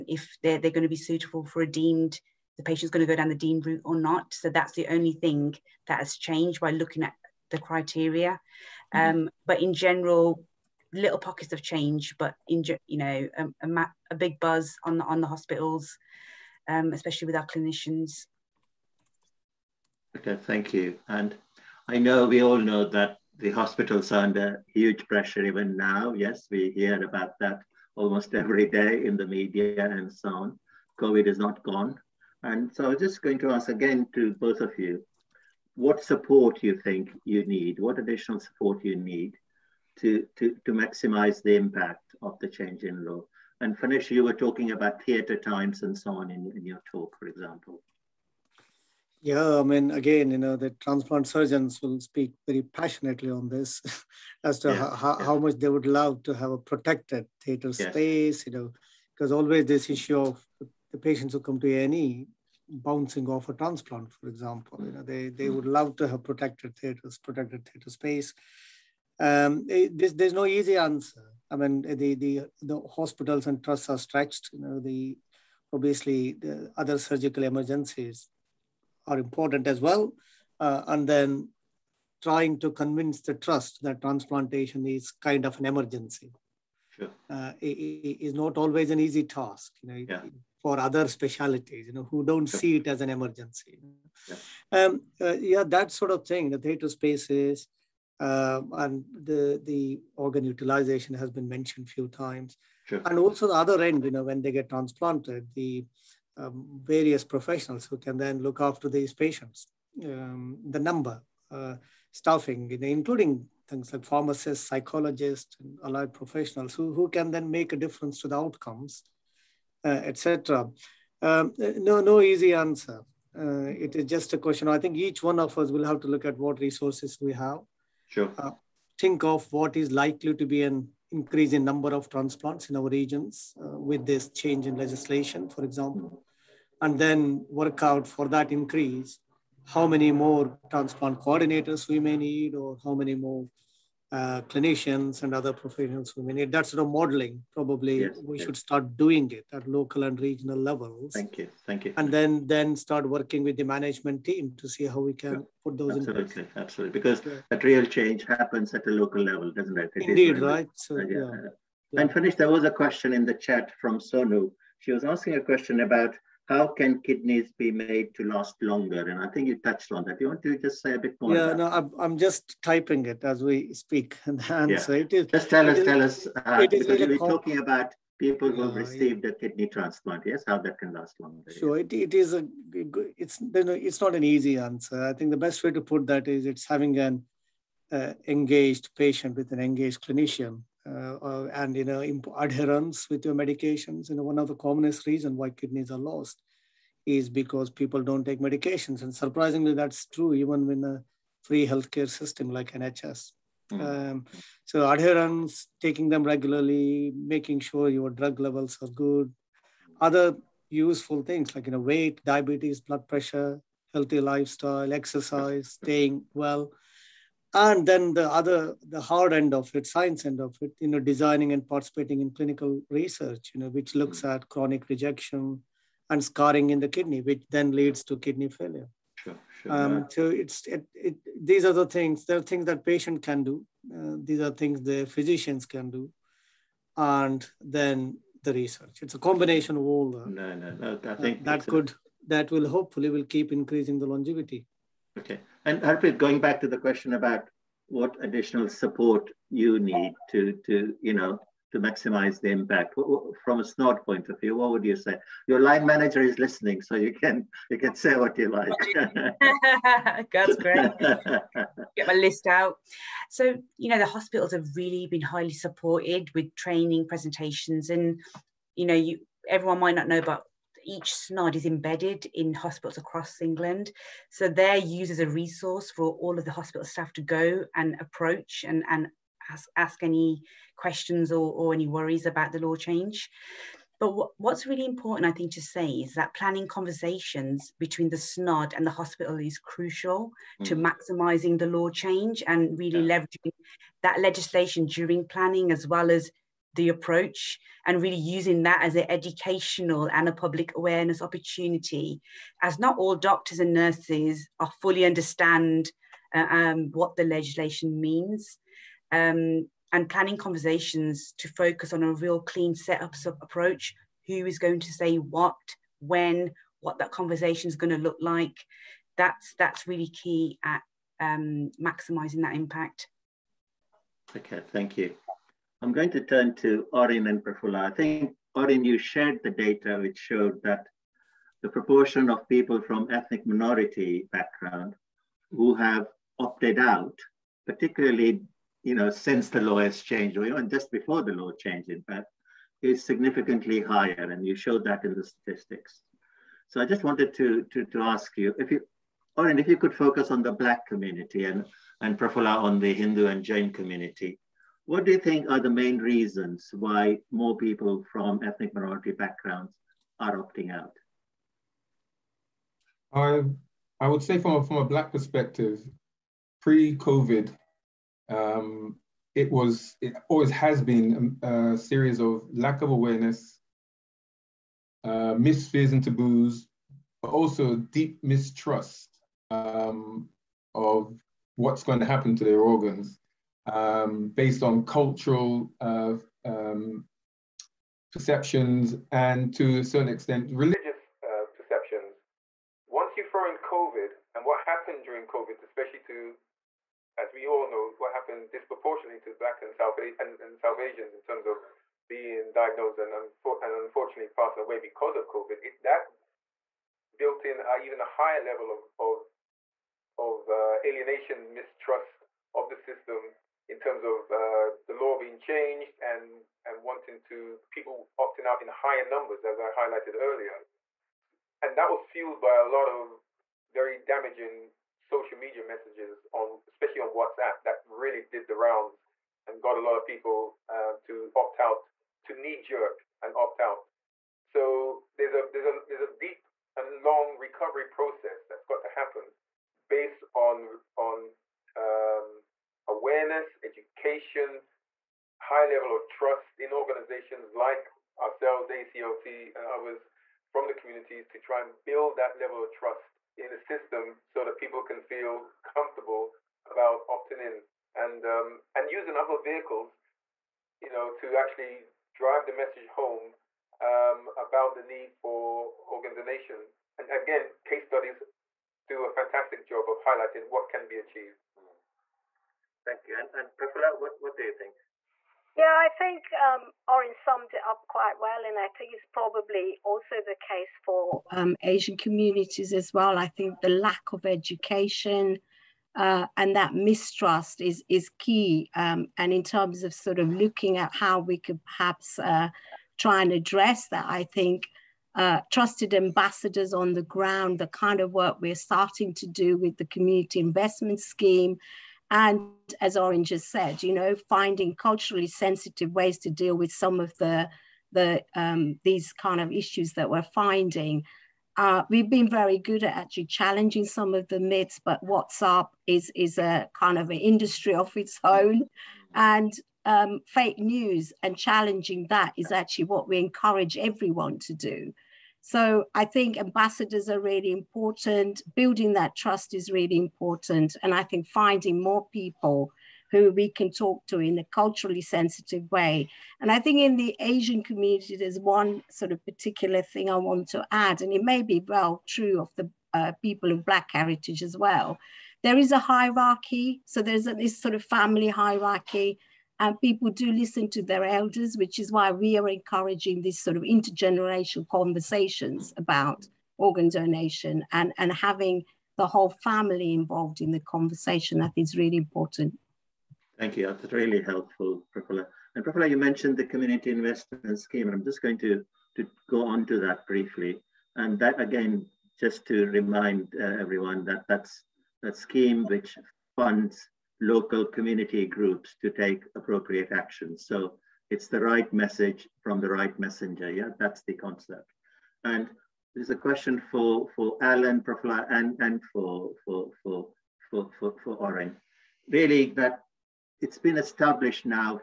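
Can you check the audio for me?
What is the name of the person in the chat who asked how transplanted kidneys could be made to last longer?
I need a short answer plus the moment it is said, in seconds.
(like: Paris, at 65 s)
Sonu, at 163 s.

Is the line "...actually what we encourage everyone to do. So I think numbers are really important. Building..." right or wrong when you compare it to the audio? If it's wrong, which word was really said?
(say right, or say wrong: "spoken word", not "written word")
wrong: "ambassadors", not "numbers".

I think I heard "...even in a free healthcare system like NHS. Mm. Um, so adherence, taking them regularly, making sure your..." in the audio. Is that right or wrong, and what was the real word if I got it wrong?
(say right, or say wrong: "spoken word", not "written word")
right.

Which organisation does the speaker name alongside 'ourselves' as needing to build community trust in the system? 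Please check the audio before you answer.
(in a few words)
ACLT.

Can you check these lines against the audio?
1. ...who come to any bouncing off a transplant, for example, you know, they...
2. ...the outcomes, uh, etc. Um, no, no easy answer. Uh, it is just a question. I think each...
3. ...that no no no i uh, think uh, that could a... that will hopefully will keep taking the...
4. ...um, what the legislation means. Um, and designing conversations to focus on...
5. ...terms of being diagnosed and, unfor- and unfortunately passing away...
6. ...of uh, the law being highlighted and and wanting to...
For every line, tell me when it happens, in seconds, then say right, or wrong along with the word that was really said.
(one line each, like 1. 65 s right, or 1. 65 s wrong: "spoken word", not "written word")
1. 61 s right
2. 118 s right
3. 240 s wrong: "increasing", not "taking"
4. 306 s wrong: "planning", not "designing"
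5. 401 s right
6. 414 s wrong: "changed", not "highlighted".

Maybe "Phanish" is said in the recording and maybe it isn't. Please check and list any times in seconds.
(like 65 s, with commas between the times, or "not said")
43 s, 162 s.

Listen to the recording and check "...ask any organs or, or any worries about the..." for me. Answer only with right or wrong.
wrong.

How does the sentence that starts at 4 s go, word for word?
So that's the only thing that has changed by looking at the criteria.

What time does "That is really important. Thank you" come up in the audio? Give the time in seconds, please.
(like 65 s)
561 s.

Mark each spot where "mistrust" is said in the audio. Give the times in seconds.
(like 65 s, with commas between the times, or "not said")
378 s, 411 s, 486 s.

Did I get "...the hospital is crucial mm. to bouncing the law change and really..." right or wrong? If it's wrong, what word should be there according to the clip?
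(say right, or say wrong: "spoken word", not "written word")
wrong: "maximising", not "bouncing".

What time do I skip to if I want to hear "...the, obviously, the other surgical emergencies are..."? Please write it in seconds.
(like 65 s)
74 s.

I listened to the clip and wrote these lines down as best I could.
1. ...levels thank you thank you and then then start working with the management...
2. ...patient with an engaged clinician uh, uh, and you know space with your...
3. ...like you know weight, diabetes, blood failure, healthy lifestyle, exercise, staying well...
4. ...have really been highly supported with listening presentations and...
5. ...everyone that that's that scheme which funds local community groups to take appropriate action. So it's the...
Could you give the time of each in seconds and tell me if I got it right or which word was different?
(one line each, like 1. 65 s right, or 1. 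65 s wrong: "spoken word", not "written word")
1. 150 s right
2. 188 s wrong: "adherence", not "space"
3. 211 s wrong: "pressure", not "failure"
4. 264 s wrong: "training", not "listening"
5. 573 s right.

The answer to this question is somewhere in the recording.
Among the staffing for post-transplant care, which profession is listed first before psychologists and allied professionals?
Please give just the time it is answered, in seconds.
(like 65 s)
114 s.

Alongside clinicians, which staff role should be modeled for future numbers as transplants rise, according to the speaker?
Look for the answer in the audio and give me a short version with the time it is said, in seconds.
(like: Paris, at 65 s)
Transplant coordinators, at 140 s.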